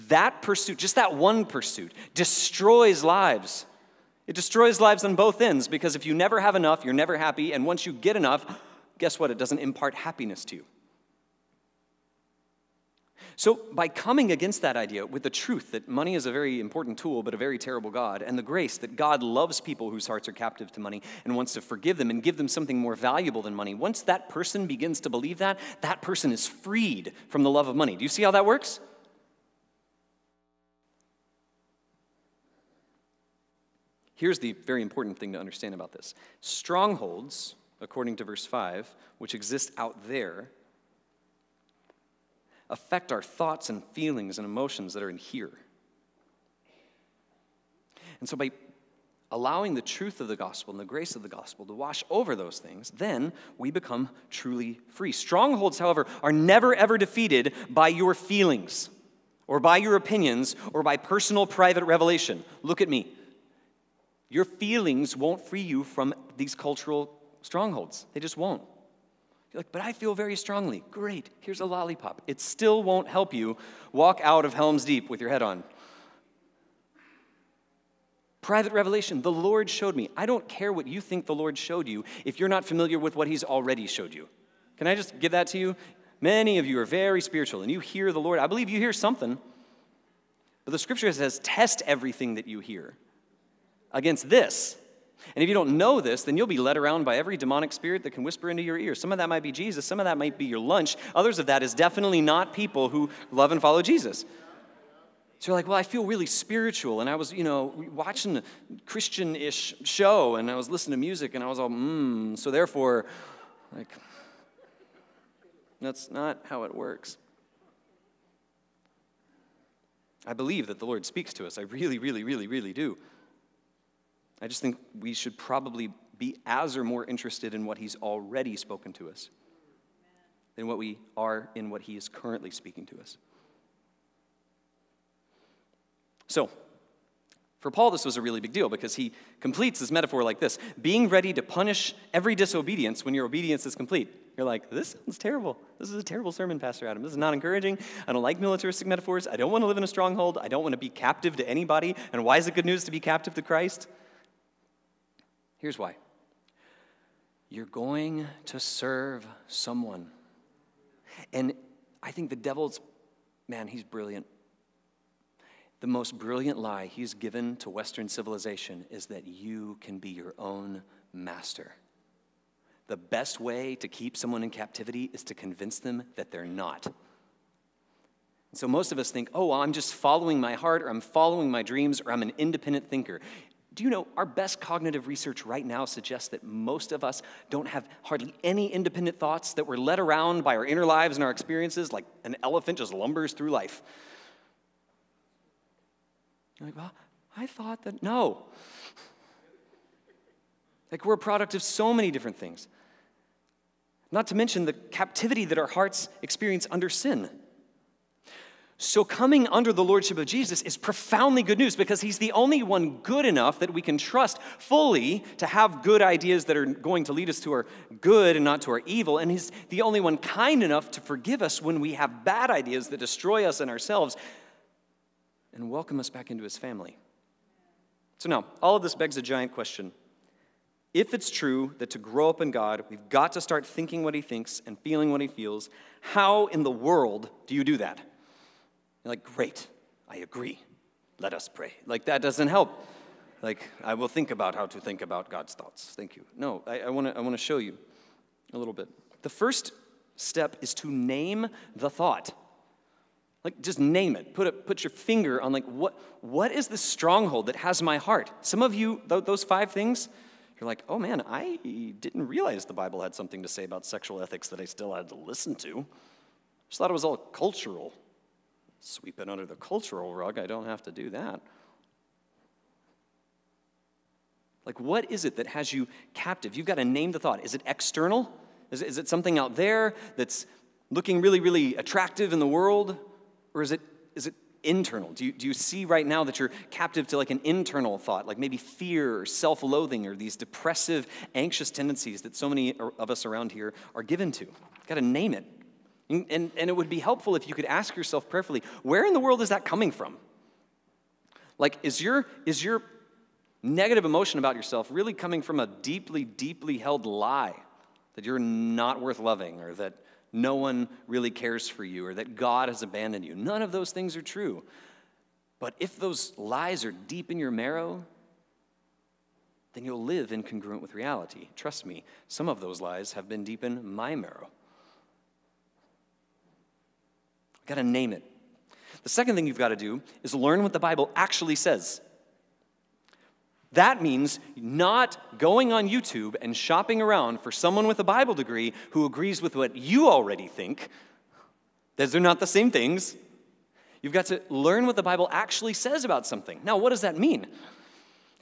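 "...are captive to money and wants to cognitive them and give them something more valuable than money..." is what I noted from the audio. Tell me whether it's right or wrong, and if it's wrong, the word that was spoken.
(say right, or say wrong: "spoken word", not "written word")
wrong: "forgive", not "cognitive".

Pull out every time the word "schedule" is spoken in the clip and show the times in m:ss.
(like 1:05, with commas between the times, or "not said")
not said.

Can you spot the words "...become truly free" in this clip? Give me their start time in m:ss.
0:53.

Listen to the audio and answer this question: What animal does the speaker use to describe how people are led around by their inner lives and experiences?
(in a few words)
An elephant.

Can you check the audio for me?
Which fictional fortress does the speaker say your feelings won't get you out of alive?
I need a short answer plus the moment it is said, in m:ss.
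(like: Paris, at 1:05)
Helm's Deep, at 1:14.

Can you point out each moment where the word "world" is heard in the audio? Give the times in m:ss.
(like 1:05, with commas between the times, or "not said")
3:56, 4:42, 4:59.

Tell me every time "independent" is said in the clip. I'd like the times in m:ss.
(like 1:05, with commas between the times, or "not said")
3:02, 3:08.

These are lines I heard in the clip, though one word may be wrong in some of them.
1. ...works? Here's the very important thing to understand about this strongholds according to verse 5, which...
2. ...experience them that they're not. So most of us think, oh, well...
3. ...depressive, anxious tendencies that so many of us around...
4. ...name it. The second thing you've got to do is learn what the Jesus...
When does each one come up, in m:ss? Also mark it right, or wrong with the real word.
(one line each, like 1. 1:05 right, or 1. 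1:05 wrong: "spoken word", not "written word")
1. 0:28 right
2. 2:55 wrong: "convince", not "experience"
3. 4:50 right
4. 5:27 wrong: "Bible", not "Jesus".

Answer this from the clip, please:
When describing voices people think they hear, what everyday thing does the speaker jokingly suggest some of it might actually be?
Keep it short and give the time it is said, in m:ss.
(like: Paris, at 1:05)
Your lunch, at 1:40.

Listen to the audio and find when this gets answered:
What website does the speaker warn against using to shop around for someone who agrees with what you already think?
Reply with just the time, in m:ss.
5:35.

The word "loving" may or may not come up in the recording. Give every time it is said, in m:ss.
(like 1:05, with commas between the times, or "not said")
5:09.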